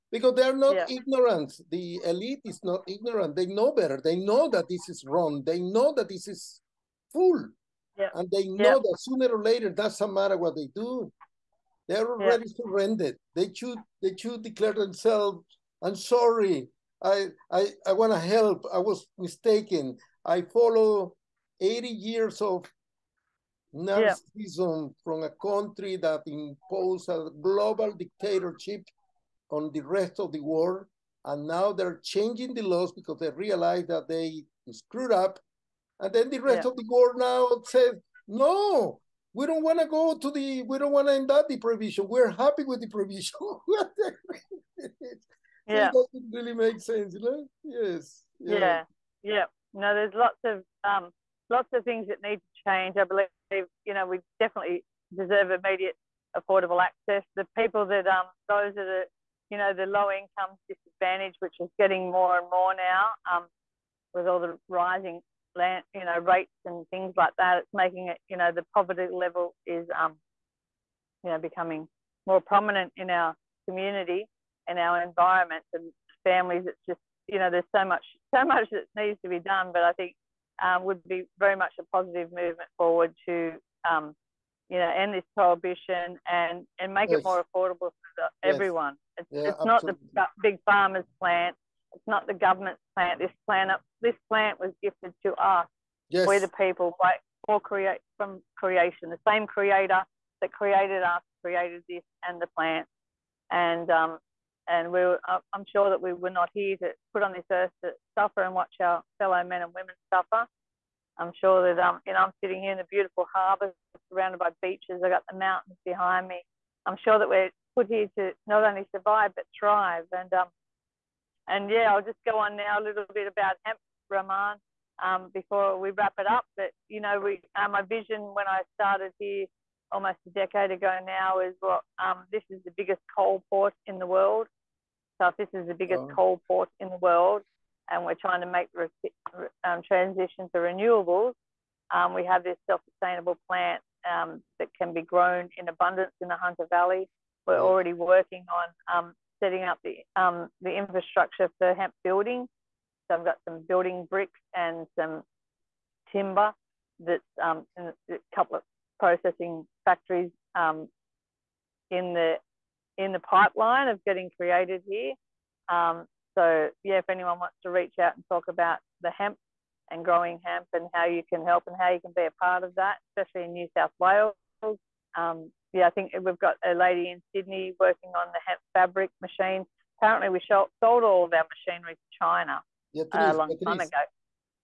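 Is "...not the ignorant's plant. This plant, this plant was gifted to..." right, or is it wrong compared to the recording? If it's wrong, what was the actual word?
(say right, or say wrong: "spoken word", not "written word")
wrong: "government", not "ignorant".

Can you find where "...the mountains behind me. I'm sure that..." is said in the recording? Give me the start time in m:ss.
1:55.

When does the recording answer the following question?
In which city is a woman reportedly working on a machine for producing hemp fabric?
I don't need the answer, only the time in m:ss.
2:57.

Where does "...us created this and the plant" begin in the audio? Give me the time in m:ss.
1:41.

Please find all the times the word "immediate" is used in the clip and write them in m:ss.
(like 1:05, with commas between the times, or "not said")
0:55.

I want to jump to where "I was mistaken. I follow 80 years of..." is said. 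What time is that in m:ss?
0:18.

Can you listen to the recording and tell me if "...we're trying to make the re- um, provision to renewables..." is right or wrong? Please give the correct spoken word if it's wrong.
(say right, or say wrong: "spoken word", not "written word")
wrong: "transition", not "provision".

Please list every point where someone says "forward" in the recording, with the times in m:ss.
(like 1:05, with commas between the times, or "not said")
1:22.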